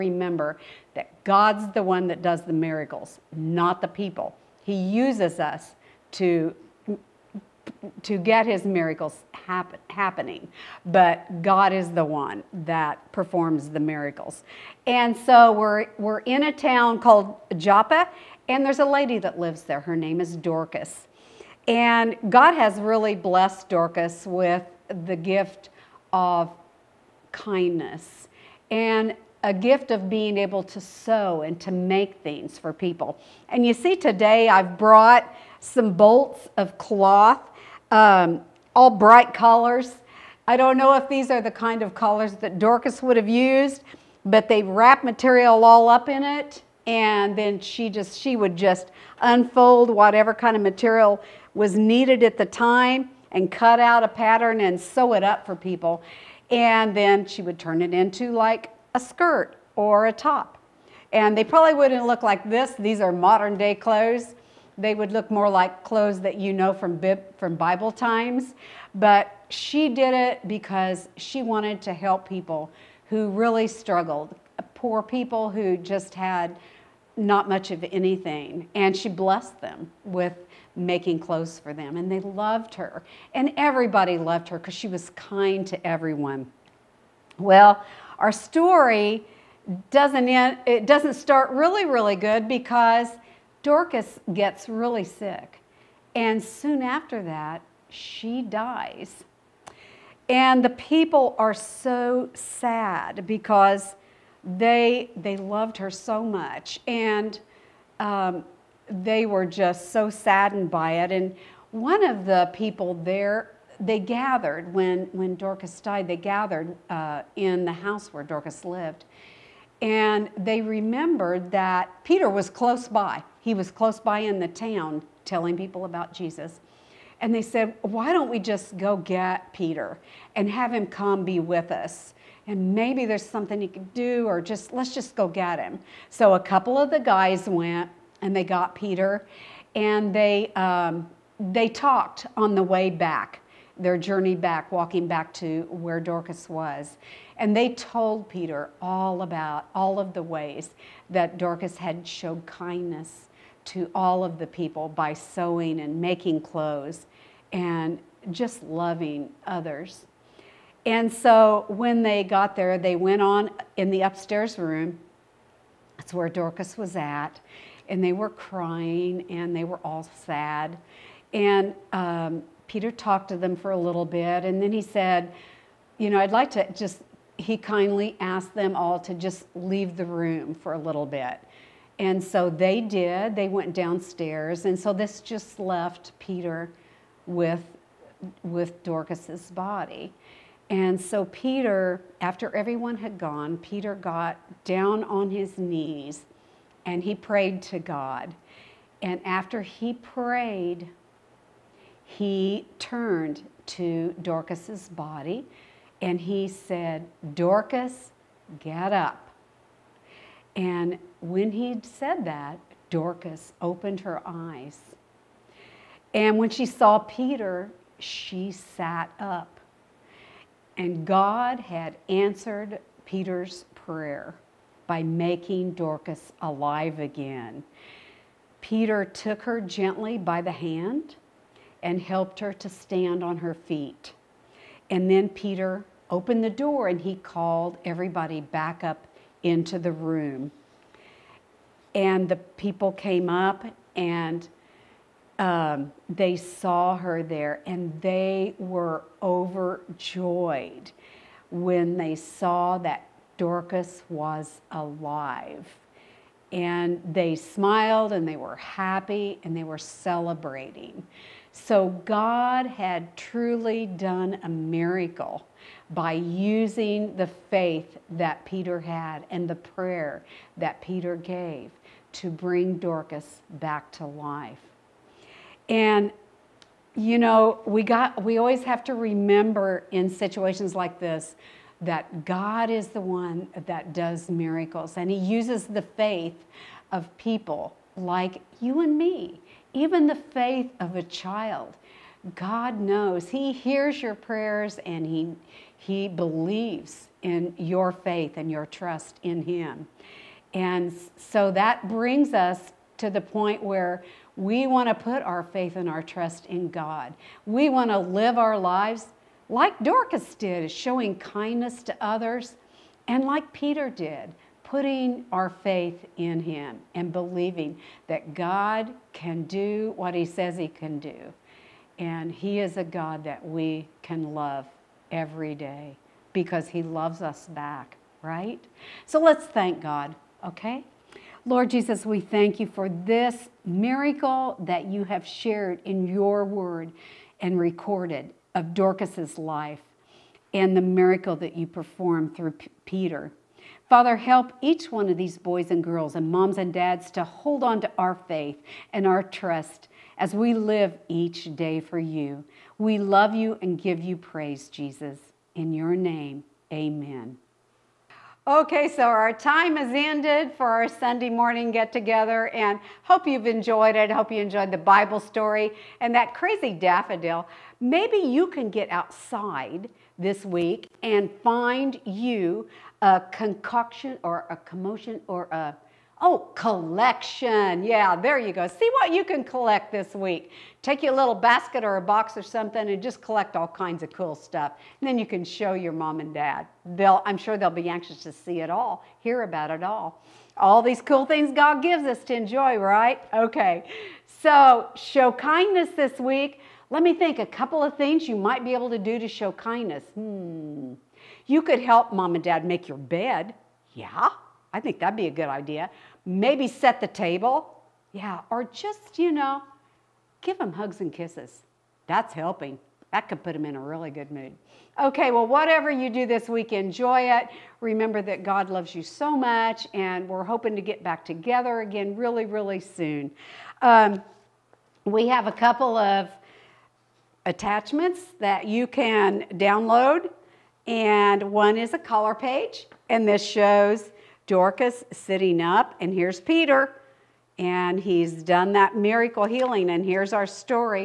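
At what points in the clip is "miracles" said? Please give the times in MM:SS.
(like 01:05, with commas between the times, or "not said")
00:02, 00:08, 00:13, 04:24, 04:44, 05:33, 05:40, 07:18.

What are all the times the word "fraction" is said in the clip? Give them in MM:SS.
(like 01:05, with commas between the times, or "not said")
not said.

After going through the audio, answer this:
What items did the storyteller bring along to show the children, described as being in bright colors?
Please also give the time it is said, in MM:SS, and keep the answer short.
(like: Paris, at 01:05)
Bolts of cloth, at 00:35.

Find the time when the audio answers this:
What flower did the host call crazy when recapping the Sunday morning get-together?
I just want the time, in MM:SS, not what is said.
06:06.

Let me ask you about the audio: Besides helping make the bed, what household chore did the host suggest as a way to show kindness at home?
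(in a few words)
Set the table.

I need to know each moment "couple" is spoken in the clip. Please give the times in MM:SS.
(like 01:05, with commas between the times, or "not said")
02:16, 06:37, 07:05.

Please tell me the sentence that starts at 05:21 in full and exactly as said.
And He is a God that we can love every day because He loves us back, right?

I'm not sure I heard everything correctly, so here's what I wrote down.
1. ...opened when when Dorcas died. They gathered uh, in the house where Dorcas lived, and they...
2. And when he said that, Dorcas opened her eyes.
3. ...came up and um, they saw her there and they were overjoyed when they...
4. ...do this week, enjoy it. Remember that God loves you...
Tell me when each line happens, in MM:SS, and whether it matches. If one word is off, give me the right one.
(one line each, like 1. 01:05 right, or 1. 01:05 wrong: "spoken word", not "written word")
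1. 01:53 wrong: "gathered", not "opened"
2. 03:30 right
3. 04:02 right
4. 06:56 right.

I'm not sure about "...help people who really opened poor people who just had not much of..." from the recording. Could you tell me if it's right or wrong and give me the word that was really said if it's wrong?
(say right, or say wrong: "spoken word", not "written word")
wrong: "struggled", not "opened".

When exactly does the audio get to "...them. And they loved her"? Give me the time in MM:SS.
01:21.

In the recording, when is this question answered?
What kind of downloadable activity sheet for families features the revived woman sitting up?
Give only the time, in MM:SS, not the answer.
07:11.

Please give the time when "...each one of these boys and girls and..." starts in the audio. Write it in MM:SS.
05:44.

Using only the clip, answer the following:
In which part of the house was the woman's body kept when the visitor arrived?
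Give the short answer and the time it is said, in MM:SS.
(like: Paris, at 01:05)
The upstairs room, at 02:44.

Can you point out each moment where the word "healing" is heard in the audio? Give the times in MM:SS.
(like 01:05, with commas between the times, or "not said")
07:19.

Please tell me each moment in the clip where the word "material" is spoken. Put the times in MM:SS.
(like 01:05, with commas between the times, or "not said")
00:45, 00:50.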